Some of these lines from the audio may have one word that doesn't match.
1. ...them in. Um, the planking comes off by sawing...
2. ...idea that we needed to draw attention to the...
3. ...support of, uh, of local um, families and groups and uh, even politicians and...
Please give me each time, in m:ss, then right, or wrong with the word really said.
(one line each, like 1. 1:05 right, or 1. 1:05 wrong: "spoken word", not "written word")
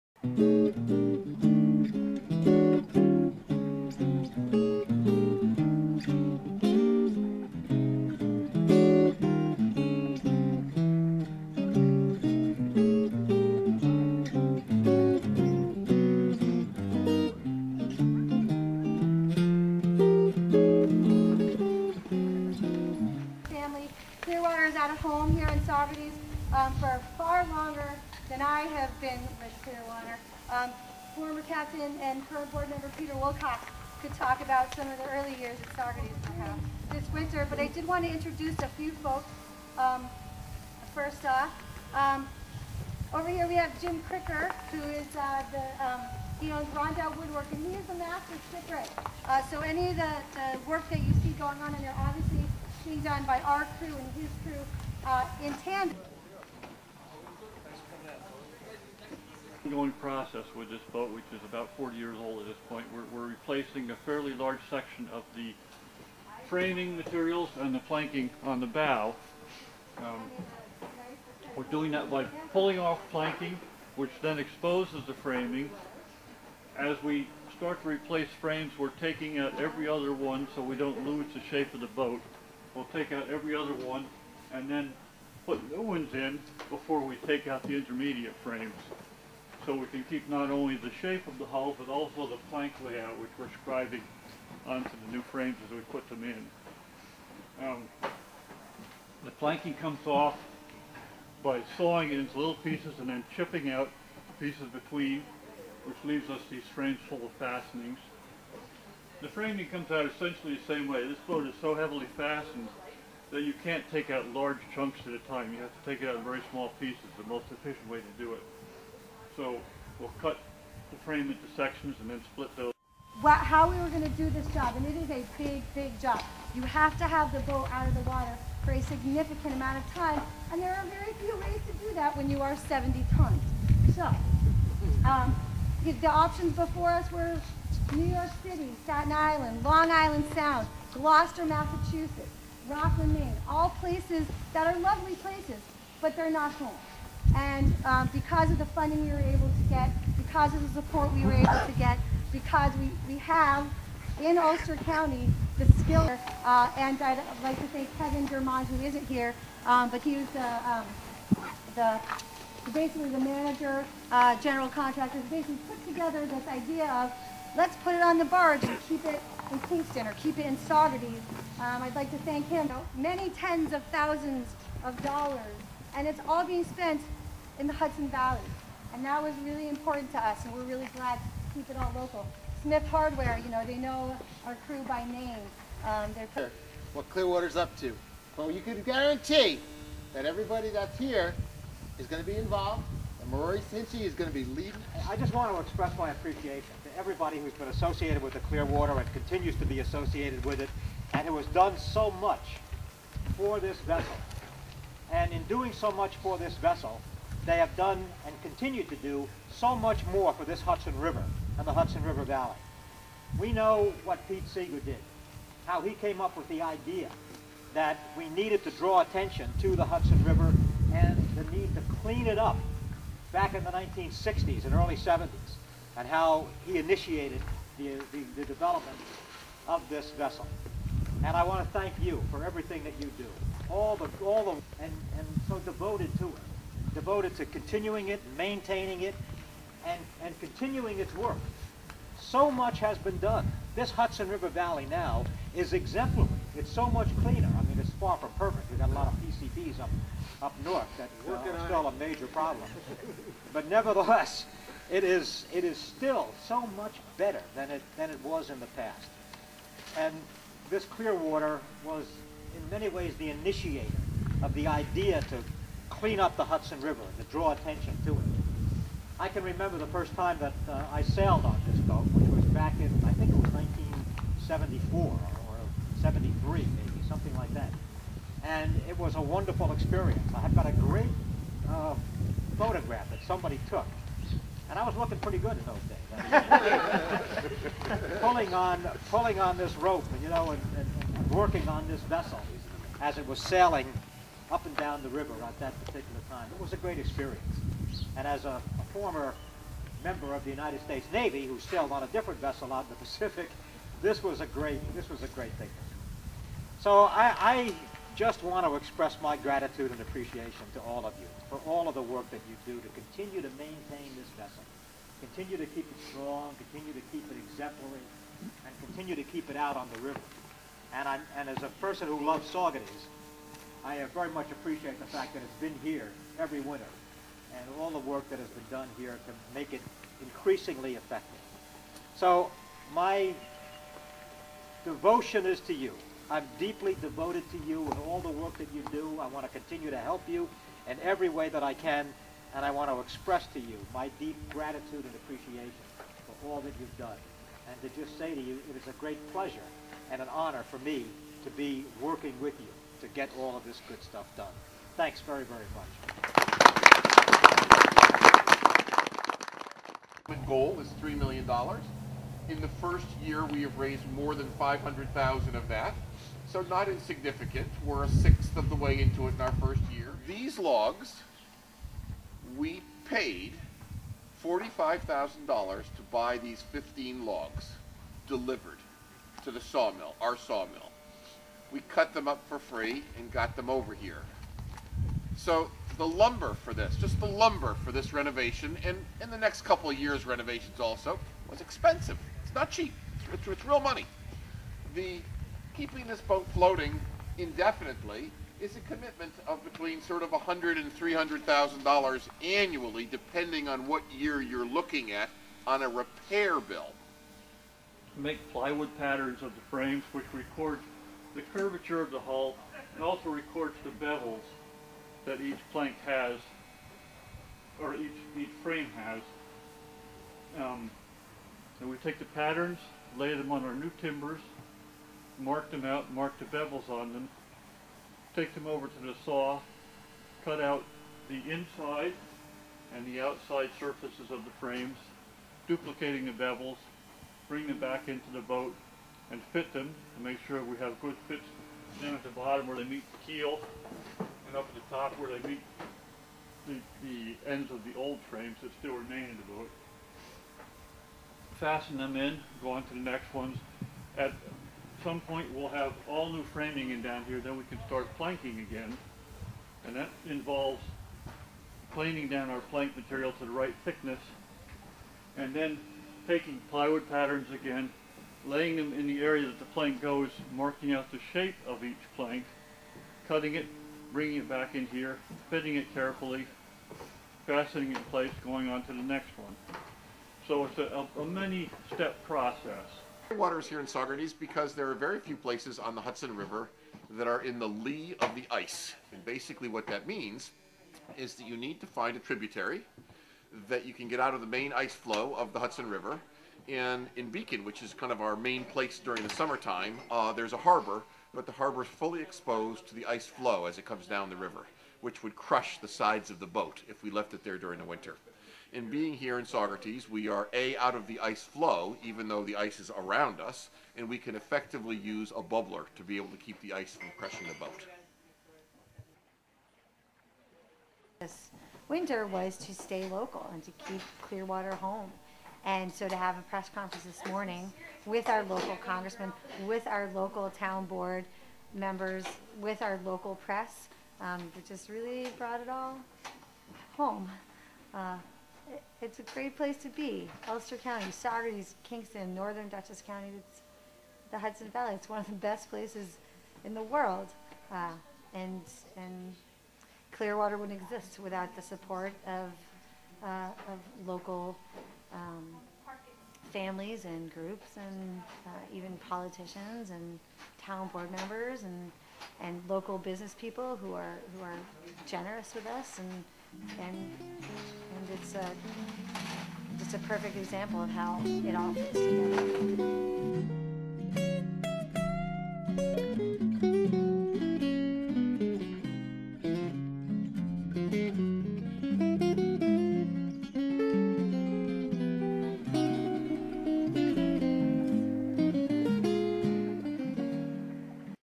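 1. 1:36 right
2. 3:36 right
3. 9:11 right.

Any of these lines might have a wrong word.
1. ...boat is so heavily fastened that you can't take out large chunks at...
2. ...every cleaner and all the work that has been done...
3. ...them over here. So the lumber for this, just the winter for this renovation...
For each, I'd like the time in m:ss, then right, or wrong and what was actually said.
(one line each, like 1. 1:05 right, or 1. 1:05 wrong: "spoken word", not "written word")
1. 1:51 right
2. 5:26 wrong: "winter", not "cleaner"
3. 6:23 wrong: "lumber", not "winter".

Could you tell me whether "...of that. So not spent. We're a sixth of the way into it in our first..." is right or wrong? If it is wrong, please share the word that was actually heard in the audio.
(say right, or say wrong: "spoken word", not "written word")
wrong: "insignificant", not "spent".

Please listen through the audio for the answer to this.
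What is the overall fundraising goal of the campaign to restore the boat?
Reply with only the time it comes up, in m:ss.
6:01.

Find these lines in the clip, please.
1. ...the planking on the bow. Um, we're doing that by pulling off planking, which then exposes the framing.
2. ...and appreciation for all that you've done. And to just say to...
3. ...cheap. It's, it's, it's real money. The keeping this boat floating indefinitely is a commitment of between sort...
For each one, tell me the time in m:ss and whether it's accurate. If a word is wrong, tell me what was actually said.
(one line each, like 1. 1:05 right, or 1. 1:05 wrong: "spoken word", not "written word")
1. 1:07 right
2. 5:45 right
3. 6:32 right.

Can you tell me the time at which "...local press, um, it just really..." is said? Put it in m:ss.
8:53.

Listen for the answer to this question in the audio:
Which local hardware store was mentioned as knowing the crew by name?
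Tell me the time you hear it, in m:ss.
3:02.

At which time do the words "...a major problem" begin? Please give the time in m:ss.
4:11.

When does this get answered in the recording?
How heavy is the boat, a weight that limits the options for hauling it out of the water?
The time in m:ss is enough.
2:12.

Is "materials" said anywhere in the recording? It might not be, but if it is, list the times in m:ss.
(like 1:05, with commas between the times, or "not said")
1:06, 7:42.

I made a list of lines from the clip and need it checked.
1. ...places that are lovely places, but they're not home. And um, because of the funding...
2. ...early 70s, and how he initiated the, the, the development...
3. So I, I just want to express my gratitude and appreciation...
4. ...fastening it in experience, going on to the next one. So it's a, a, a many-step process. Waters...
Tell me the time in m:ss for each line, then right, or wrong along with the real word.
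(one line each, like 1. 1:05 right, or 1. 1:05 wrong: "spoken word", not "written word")
1. 2:23 right
2. 3:44 right
3. 5:06 right
4. 7:57 wrong: "place", not "experience".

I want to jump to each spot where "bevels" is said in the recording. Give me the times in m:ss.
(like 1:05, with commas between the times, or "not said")
6:54, 7:06, 7:16.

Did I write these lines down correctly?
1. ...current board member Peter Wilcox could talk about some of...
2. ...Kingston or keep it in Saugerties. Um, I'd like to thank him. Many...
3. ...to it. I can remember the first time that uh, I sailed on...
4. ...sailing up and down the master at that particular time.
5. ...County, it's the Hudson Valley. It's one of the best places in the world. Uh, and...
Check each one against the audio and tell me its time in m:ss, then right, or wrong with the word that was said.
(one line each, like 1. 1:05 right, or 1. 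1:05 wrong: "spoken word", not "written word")
1. 0:32 right
2. 2:49 right
3. 4:28 right
4. 4:53 wrong: "river", not "master"
5. 9:03 right.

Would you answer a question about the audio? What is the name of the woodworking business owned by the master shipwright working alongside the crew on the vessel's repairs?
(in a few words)
Rondout Woodwork.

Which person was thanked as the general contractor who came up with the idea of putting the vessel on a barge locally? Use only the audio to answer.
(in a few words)
Kevin Germond.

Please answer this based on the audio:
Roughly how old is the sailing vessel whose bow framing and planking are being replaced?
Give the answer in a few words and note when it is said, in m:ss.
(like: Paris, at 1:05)
about 40 years, at 1:01.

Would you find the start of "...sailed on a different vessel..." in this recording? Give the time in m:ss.
5:01.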